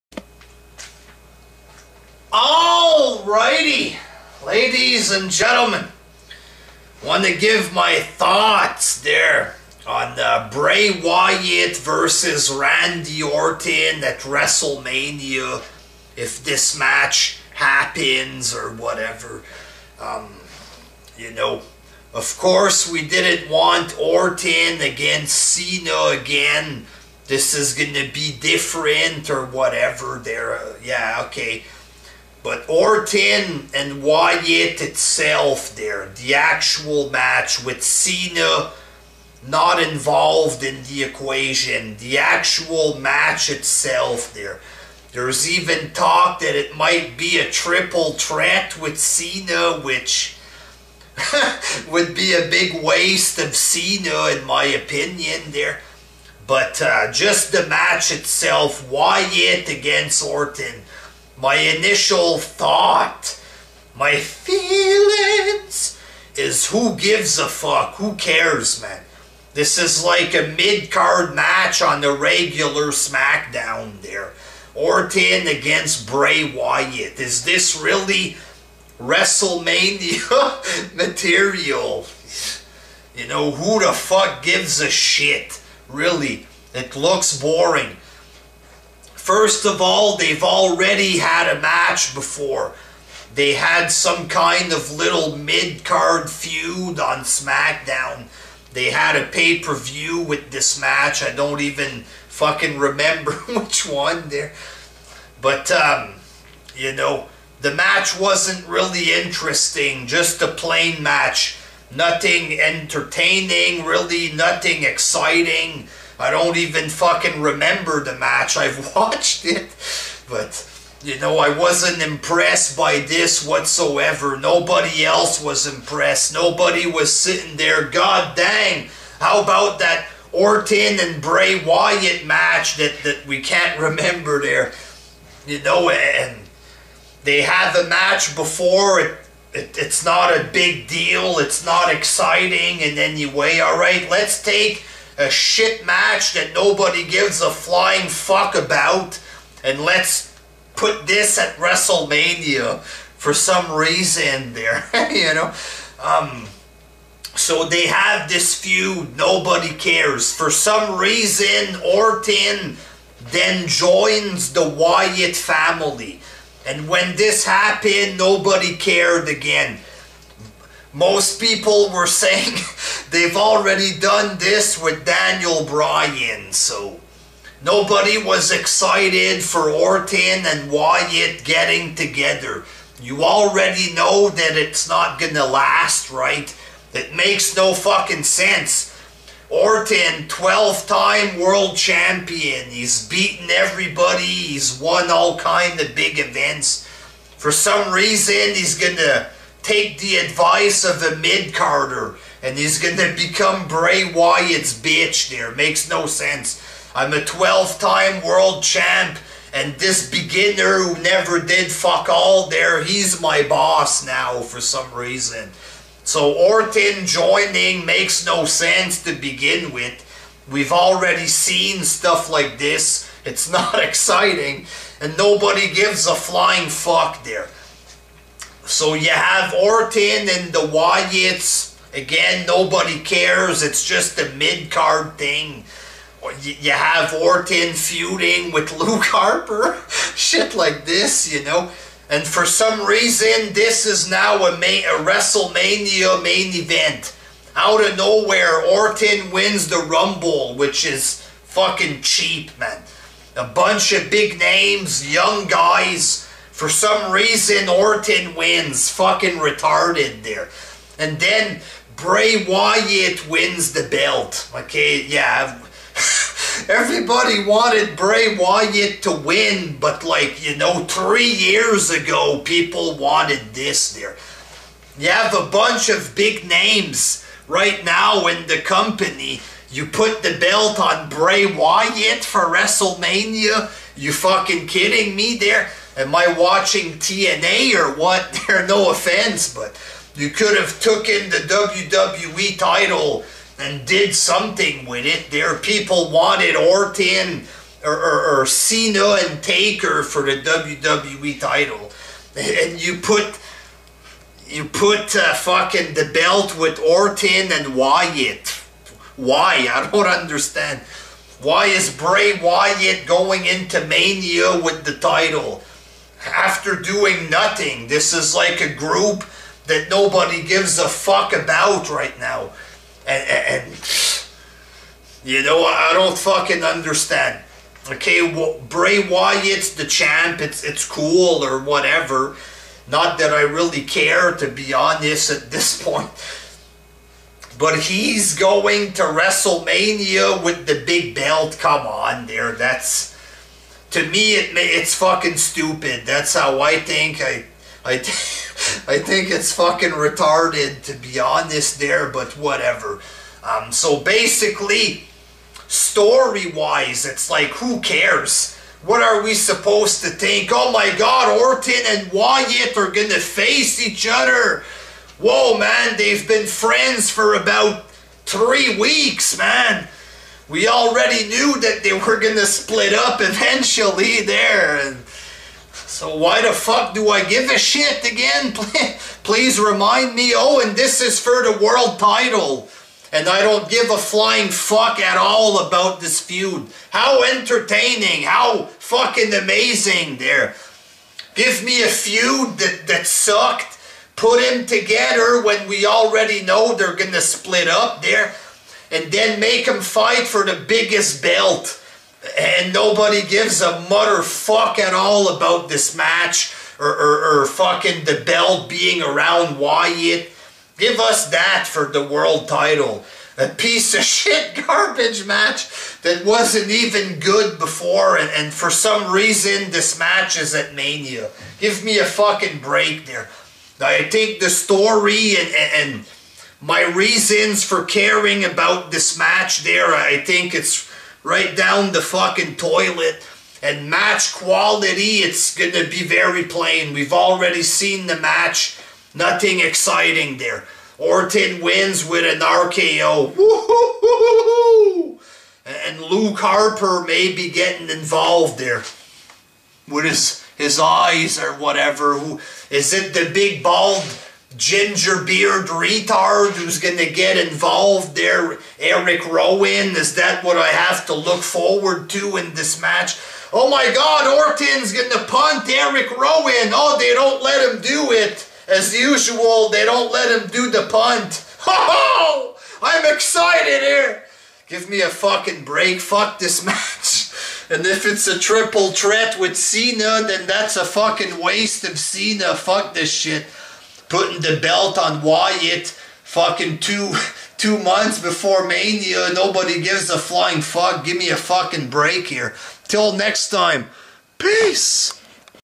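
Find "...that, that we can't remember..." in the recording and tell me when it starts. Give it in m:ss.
2:12.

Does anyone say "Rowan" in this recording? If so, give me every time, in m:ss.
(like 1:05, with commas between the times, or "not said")
7:39, 7:46.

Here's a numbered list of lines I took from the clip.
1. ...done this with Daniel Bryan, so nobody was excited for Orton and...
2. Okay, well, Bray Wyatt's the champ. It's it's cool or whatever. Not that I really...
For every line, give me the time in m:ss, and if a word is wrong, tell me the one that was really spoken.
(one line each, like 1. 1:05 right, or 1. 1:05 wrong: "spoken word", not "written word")
1. 2:53 right
2. 5:27 right.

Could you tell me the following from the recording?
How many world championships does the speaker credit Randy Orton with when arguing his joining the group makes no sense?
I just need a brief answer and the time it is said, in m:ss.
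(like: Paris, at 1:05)
12, at 3:10.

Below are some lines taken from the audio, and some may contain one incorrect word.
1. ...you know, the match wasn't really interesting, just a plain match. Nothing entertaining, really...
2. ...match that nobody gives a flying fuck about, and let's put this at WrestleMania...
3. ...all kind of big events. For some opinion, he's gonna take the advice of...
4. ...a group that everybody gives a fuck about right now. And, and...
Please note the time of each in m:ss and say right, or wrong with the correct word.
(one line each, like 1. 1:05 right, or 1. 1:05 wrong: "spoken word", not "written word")
1. 1:46 right
2. 2:25 right
3. 3:15 wrong: "reason", not "opinion"
4. 5:18 wrong: "nobody", not "everybody".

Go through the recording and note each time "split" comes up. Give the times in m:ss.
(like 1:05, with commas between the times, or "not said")
6:12, 6:37.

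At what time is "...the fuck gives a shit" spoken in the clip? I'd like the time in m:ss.
1:23.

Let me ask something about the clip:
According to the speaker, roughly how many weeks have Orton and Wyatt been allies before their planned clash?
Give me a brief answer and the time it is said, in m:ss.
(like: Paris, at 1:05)
3, at 6:08.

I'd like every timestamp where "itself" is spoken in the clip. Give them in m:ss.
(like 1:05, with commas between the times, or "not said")
0:34, 0:43, 0:58.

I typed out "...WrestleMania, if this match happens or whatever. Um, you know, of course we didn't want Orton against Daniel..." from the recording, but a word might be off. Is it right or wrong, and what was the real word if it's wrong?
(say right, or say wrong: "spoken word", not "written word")
wrong: "Cena", not "Daniel".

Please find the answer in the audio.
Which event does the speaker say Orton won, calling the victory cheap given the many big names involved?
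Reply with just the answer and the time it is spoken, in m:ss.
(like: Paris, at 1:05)
the Rumble, at 4:09.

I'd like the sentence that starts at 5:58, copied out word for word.
What are we supposed to think?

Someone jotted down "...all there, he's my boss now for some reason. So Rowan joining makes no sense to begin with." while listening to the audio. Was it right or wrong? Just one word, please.
wrong.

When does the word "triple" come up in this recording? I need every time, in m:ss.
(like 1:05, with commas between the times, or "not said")
0:47, 7:58.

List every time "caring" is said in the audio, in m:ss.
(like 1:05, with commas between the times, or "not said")
7:07.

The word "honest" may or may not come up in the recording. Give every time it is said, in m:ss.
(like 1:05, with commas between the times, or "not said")
5:34, 5:51.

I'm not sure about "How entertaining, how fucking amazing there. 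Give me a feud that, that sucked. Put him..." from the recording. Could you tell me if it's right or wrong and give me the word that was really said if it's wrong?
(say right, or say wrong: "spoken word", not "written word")
right.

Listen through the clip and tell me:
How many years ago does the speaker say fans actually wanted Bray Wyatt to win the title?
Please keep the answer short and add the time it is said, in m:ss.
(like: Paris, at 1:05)
3, at 4:30.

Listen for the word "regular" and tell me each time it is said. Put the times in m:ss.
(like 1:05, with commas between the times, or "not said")
1:12.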